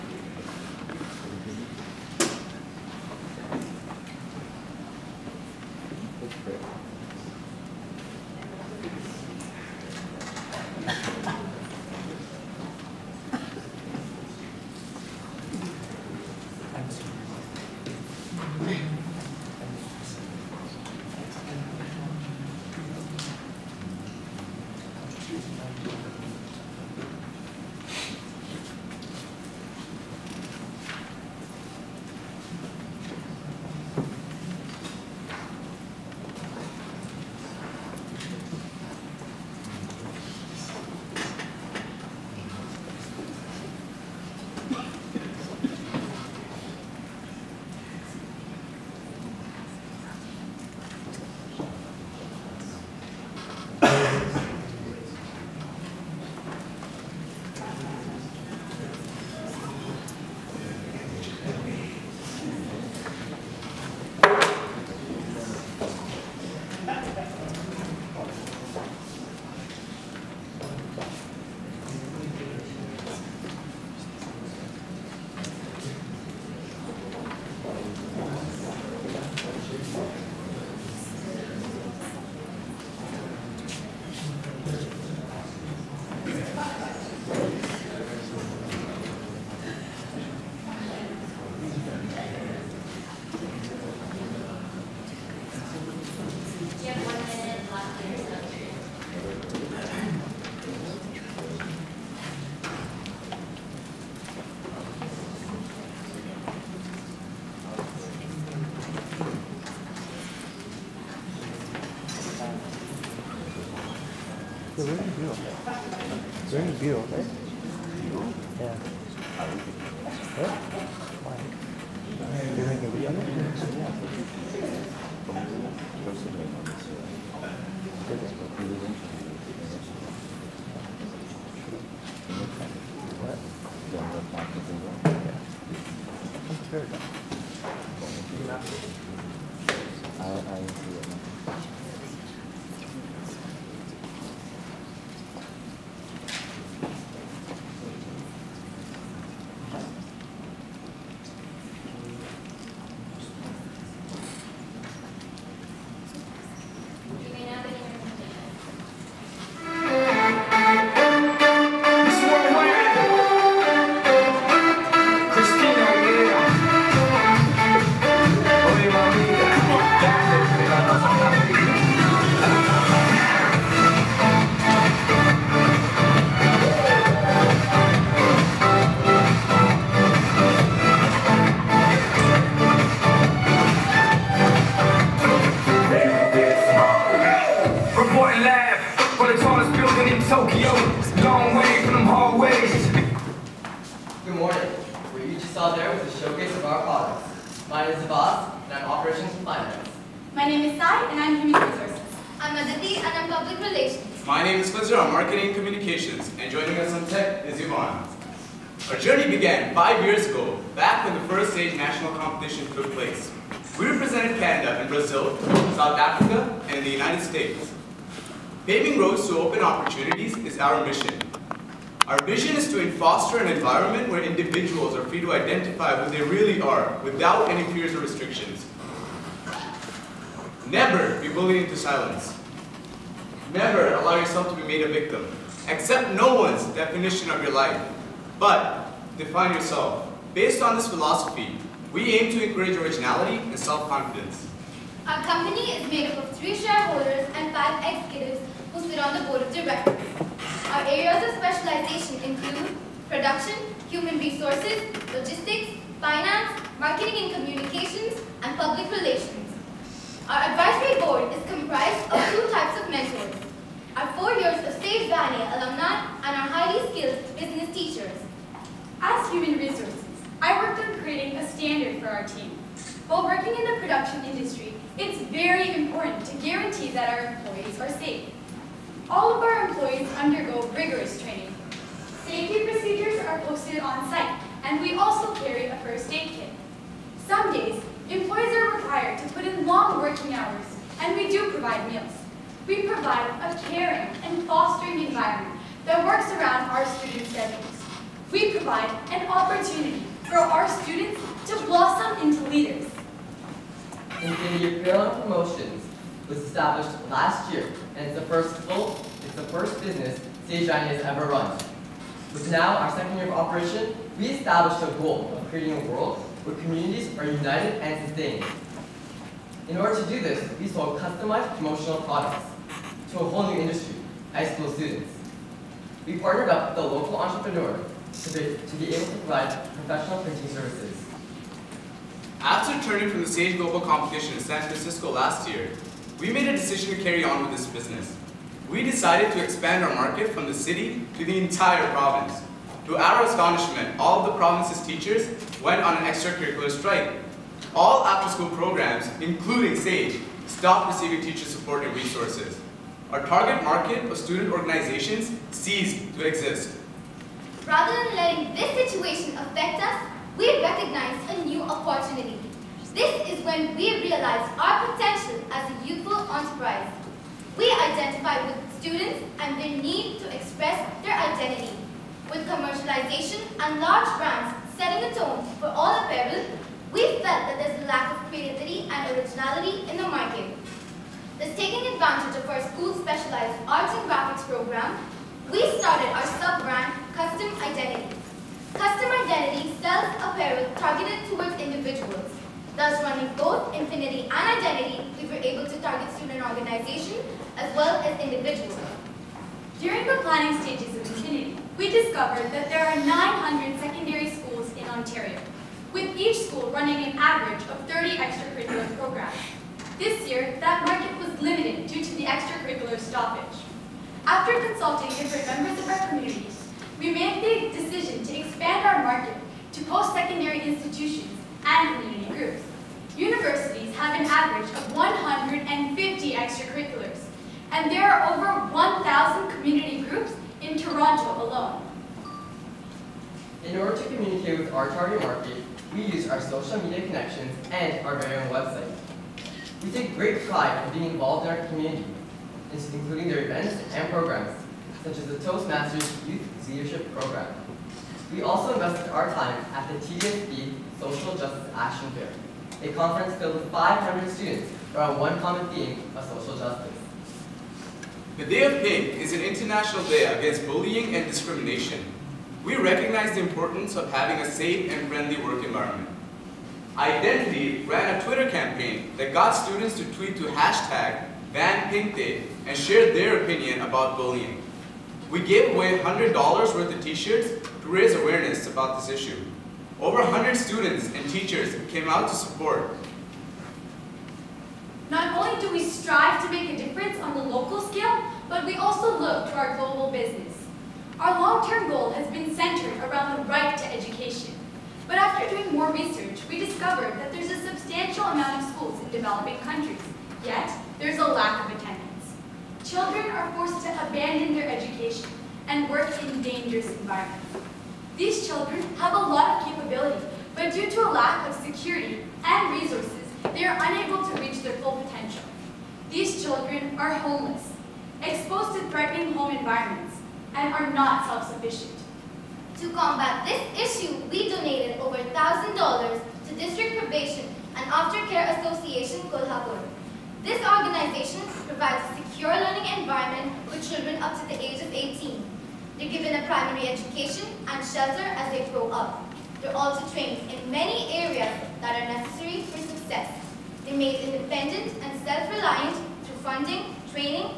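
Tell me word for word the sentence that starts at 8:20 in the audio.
Yet, there's a lack of attendance.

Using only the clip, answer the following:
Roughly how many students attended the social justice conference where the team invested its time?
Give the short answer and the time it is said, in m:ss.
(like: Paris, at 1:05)
500, at 7:33.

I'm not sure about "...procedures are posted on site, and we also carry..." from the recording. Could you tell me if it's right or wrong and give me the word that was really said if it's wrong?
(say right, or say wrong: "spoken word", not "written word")
right.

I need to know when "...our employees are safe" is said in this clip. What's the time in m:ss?
4:37.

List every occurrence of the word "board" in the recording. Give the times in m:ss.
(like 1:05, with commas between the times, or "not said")
4:09, 4:21.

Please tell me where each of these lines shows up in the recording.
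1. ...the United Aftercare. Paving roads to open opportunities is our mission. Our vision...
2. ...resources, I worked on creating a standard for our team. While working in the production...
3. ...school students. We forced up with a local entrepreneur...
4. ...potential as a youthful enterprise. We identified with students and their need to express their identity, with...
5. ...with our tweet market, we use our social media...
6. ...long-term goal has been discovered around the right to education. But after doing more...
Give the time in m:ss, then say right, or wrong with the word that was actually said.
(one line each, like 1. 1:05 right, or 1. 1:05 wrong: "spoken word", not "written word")
1. 3:36 wrong: "States", not "Aftercare"
2. 4:29 right
3. 5:24 wrong: "partnered", not "forced"
4. 6:04 right
5. 7:14 wrong: "target", not "tweet"
6. 8:11 wrong: "centered", not "discovered".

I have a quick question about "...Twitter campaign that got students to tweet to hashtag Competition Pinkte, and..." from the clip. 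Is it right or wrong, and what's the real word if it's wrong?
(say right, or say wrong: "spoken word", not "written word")
wrong: "Van", not "Competition".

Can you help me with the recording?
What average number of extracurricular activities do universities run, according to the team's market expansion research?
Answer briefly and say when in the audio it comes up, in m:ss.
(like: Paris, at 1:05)
150, at 7:04.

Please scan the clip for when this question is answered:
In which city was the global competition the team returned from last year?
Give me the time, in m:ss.
5:34.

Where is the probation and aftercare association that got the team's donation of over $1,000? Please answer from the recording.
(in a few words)
Kolhapur.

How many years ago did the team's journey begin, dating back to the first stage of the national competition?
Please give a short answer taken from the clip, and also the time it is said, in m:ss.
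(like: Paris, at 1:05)
5, at 3:29.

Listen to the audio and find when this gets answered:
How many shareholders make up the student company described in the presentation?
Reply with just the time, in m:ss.
4:06.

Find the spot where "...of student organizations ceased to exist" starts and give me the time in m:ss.
5:54.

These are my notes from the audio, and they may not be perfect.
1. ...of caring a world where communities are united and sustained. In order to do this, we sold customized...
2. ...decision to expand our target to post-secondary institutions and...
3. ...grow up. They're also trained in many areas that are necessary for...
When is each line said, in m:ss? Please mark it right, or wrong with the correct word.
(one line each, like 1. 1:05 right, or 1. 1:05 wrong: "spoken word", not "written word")
1. 5:15 wrong: "creating", not "caring"
2. 6:57 wrong: "market", not "target"
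3. 8:58 right.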